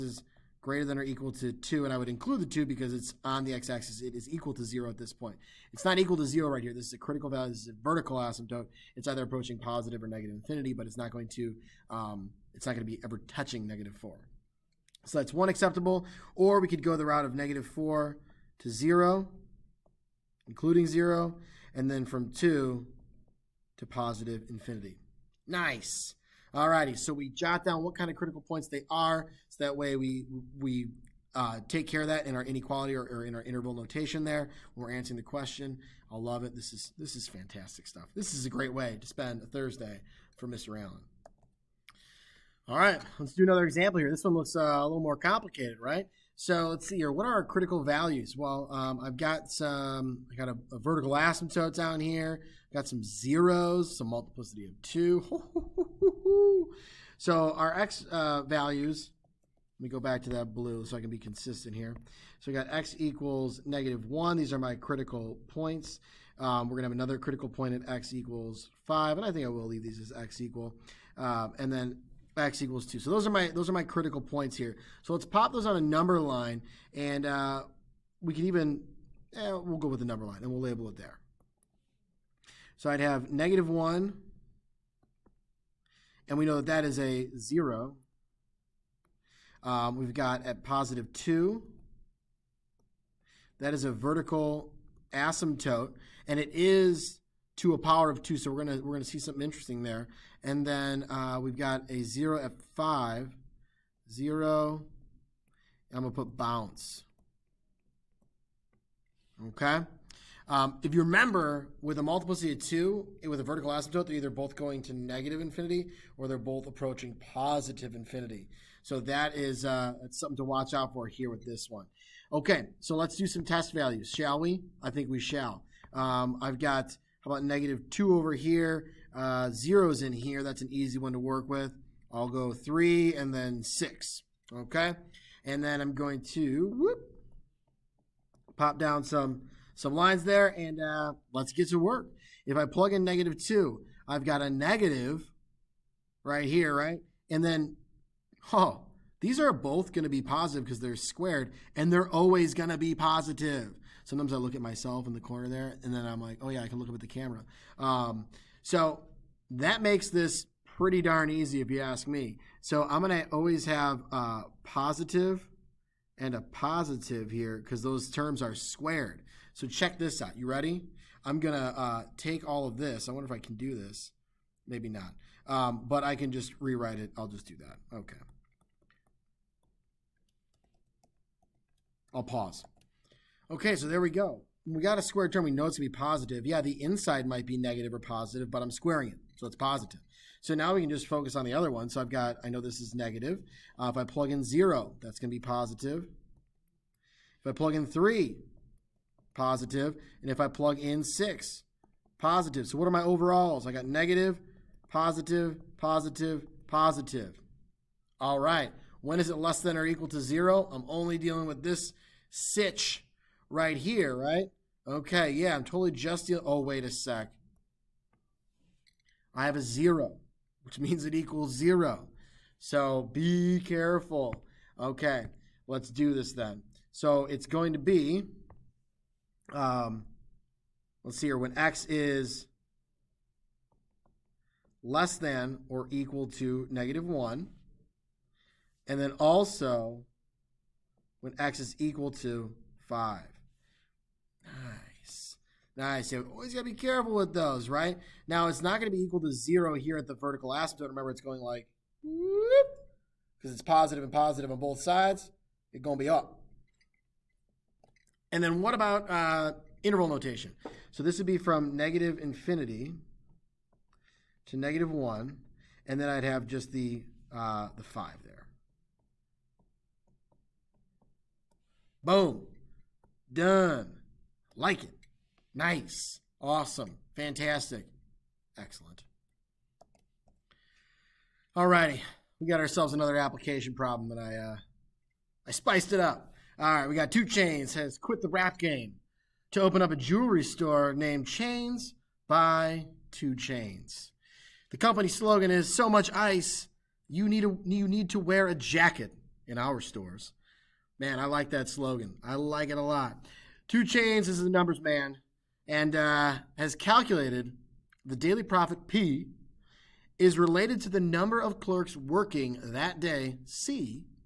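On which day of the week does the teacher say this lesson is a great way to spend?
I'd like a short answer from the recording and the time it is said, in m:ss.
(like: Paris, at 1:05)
Thursday, at 0:39.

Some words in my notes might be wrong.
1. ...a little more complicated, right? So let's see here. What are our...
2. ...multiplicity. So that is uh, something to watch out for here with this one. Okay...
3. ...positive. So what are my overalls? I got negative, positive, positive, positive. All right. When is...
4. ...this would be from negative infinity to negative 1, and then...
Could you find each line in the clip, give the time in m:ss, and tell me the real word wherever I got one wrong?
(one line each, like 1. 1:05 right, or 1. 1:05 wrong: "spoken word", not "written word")
1. 0:44 right
2. 1:57 wrong: "infinity", not "multiplicity"
3. 3:22 right
4. 4:21 right.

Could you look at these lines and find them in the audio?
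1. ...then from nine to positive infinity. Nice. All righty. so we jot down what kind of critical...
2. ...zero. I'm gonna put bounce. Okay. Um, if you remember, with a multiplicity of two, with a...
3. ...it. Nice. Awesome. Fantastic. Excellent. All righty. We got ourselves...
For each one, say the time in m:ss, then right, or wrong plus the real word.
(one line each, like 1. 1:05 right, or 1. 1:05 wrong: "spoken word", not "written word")
1. 0:21 wrong: "two", not "nine"
2. 1:44 right
3. 4:34 right.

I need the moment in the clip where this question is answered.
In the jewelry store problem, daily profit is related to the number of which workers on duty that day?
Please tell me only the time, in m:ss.
5:11.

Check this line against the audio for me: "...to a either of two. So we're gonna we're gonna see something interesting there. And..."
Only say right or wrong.
wrong.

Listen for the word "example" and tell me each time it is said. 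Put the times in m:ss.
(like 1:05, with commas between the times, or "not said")
0:43.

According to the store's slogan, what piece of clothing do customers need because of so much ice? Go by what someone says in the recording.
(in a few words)
a jacket.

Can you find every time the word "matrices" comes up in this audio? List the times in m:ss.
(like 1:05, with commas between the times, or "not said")
not said.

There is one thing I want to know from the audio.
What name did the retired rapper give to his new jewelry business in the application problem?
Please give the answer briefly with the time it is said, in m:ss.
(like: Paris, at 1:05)
Chains by 2 Chainz, at 4:51.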